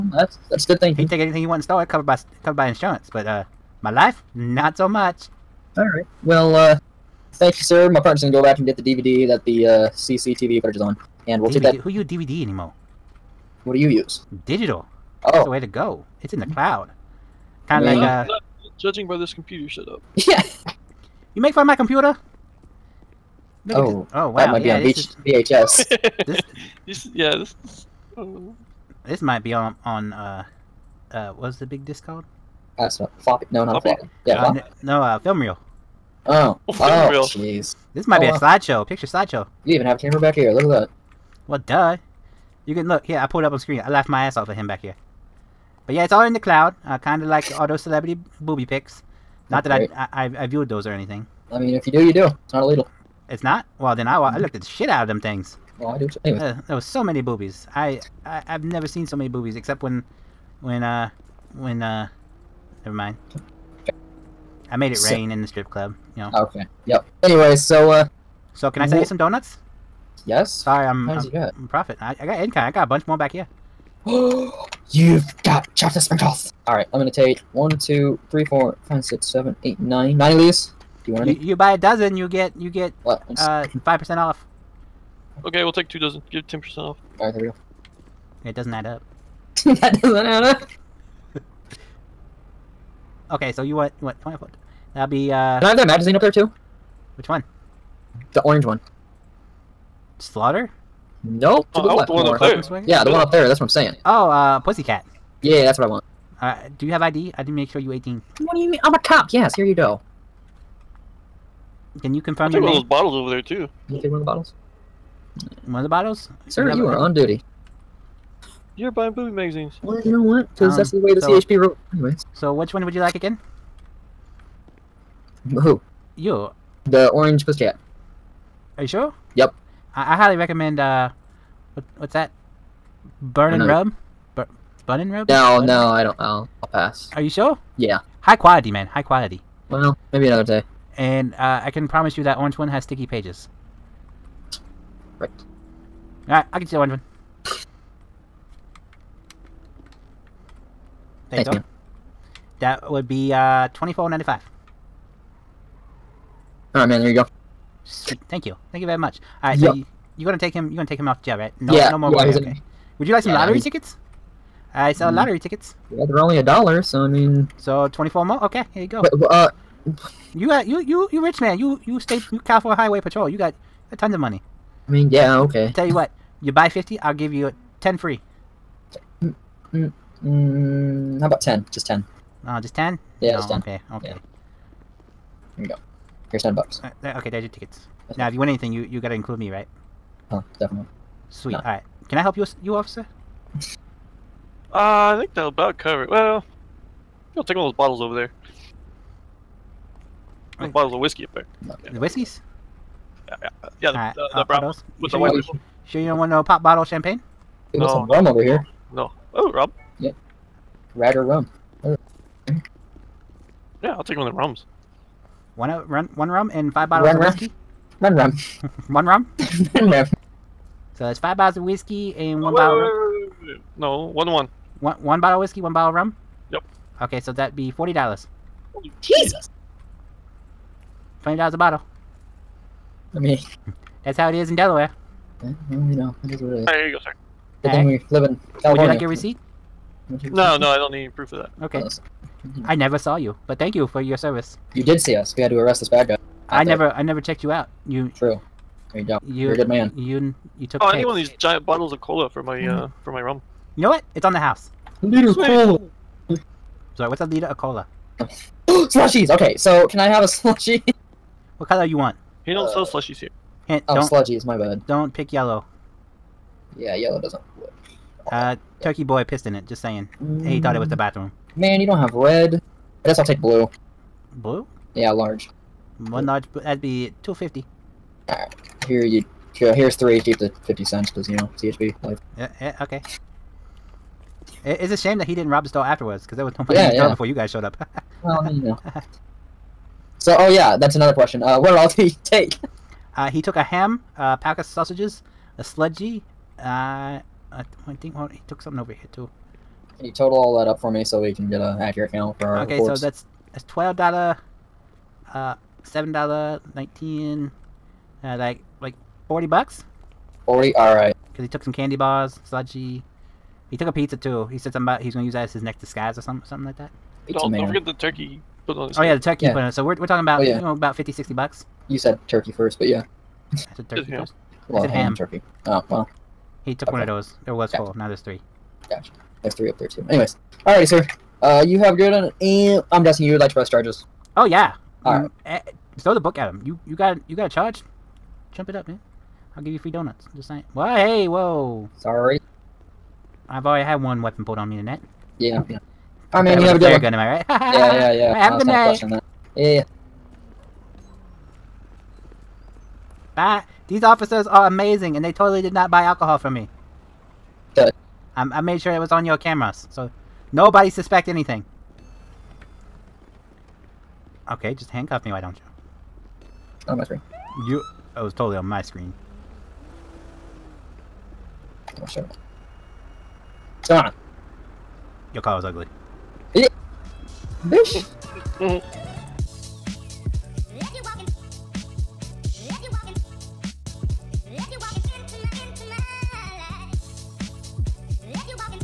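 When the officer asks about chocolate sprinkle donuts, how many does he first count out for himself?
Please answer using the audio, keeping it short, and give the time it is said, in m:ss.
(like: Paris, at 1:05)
9, at 1:20.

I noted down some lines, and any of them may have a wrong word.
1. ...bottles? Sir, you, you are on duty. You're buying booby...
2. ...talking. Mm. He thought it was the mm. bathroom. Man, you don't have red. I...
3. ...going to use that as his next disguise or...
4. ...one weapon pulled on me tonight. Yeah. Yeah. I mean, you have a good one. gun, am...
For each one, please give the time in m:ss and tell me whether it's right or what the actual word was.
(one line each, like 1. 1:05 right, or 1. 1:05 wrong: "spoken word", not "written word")
1. 1:55 right
2. 4:29 wrong: "saying", not "talking"
3. 5:15 right
4. 5:44 right.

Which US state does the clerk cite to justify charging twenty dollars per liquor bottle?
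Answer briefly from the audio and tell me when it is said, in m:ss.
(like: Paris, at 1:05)
Delaware, at 3:54.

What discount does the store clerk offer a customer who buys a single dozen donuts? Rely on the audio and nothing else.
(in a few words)
5 percent.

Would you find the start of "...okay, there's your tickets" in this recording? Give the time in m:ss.
3:07.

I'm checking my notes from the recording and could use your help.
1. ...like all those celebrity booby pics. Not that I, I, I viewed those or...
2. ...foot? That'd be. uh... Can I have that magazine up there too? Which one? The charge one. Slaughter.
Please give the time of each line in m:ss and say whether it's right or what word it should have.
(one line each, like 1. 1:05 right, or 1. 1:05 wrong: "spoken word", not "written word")
1. 0:47 right
2. 1:34 wrong: "orange", not "charge".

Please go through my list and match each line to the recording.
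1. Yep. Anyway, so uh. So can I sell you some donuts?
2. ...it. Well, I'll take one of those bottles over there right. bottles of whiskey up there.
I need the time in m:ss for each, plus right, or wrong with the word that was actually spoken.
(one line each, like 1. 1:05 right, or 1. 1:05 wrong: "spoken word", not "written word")
1. 1:06 right
2. 3:16 right.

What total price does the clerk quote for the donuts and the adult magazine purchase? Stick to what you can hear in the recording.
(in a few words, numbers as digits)
$24.95.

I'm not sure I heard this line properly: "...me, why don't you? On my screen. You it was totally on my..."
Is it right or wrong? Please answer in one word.
right.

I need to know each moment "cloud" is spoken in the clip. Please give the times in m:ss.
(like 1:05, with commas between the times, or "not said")
0:16, 0:46.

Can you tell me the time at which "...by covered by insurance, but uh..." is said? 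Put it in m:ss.
0:02.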